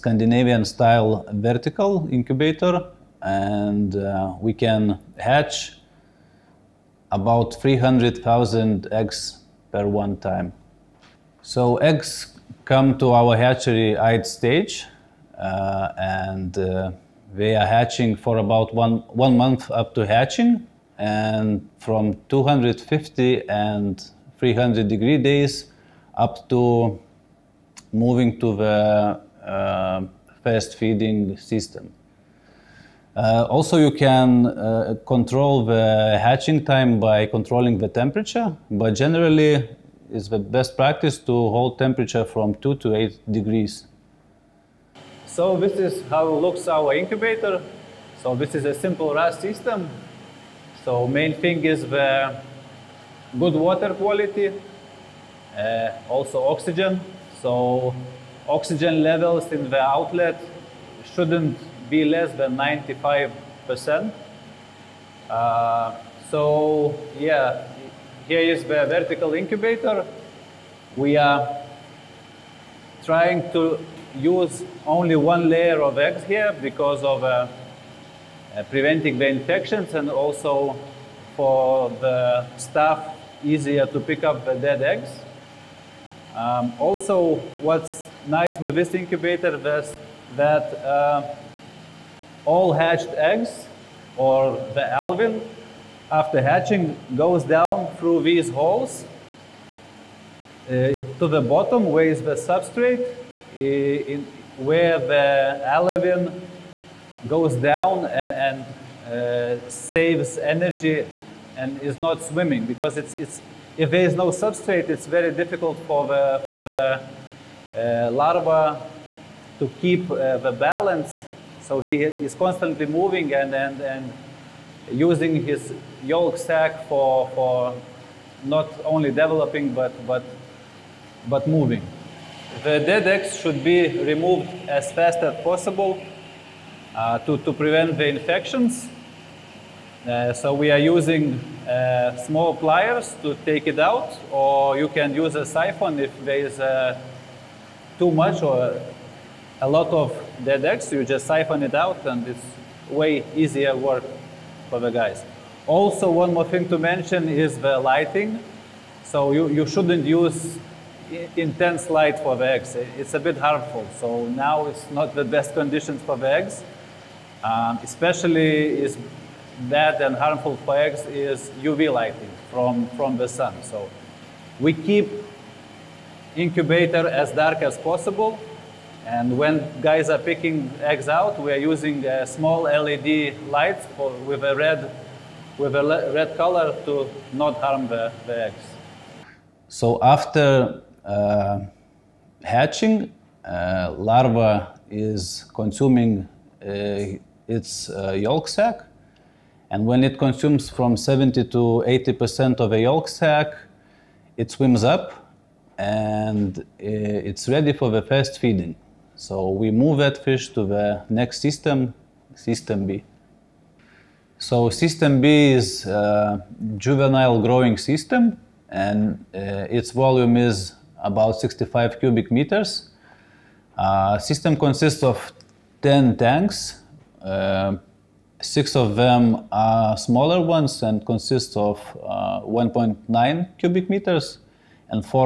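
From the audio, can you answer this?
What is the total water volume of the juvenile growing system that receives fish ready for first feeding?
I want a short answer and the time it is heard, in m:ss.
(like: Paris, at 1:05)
65 cubic meters, at 3:41.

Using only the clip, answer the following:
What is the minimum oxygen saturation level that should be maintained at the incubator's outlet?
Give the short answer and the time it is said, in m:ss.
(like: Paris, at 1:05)
95%, at 1:02.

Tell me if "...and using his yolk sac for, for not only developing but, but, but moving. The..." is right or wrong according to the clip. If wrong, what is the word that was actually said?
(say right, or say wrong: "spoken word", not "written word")
right.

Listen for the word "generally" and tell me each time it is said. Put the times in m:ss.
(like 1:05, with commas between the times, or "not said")
0:38.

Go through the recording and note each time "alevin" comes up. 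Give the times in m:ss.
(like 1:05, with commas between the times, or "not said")
1:34, 1:45.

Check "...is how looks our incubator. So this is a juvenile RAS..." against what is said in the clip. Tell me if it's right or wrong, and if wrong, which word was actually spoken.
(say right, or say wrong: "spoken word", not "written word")
wrong: "simple", not "juvenile".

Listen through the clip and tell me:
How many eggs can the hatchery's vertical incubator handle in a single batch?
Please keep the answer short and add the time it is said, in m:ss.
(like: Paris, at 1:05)
300,000, at 0:07.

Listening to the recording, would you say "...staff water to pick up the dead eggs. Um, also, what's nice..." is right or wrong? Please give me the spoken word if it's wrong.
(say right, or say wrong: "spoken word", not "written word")
wrong: "easier", not "water".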